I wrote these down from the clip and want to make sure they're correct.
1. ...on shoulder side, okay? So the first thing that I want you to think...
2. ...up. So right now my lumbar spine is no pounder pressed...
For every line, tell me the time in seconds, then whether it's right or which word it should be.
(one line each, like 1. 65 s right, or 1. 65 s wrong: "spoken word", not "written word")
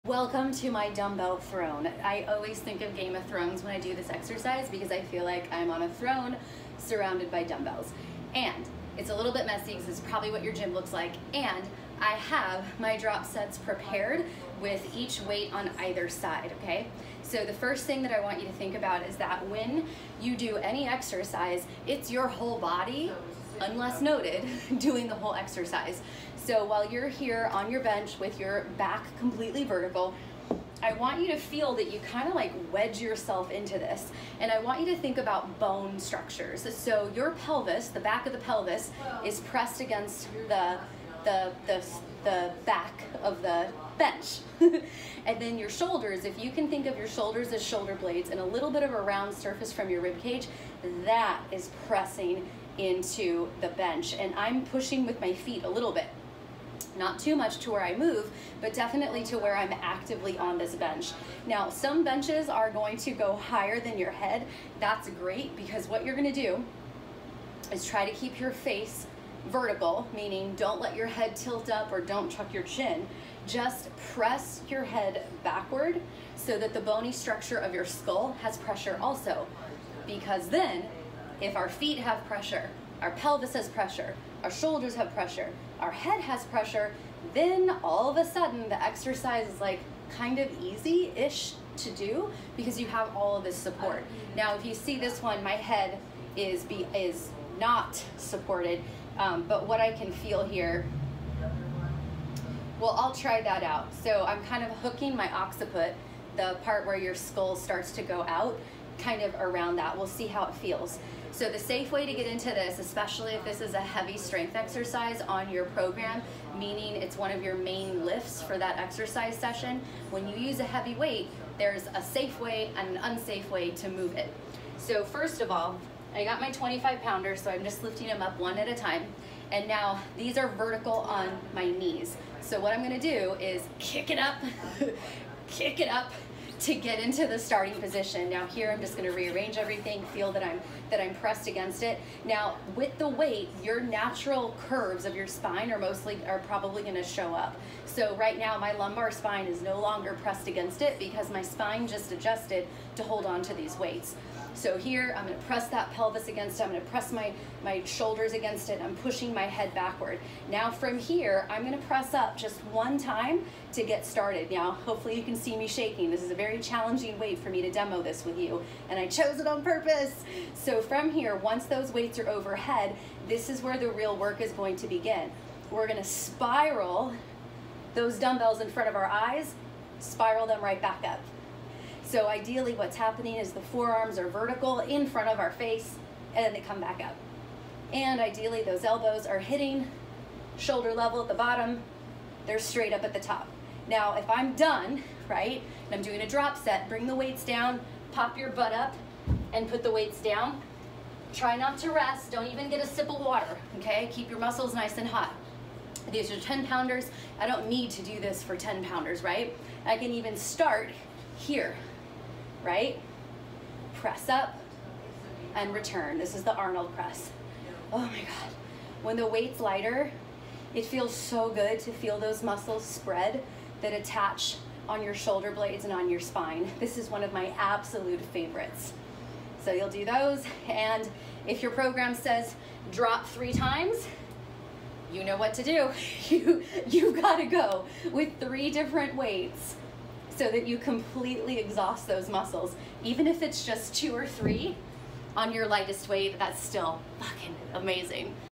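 1. 15 s wrong: "either", not "shoulder"
2. 147 s wrong: "longer", not "pounder".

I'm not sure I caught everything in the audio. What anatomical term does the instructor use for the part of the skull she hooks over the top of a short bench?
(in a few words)
occiput.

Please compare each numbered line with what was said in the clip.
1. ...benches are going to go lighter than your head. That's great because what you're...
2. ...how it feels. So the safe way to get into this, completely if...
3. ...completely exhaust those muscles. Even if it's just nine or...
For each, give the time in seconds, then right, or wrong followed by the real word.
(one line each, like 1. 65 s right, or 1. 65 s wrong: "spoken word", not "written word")
1. 62 s wrong: "higher", not "lighter"
2. 110 s wrong: "especially", not "completely"
3. 240 s wrong: "two", not "nine".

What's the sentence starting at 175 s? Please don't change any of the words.
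We're gonna spiral those dumbbells in front of our eyes, spiral them right back up.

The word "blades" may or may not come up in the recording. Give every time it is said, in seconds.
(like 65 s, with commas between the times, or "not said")
48 s, 225 s.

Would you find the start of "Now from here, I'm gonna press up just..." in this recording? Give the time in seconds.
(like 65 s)
160 s.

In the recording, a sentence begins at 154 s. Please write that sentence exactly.
So here, I'm gonna press that pelvis against it.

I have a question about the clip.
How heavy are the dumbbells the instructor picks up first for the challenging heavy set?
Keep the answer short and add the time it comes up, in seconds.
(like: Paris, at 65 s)
25 pounds, at 126 s.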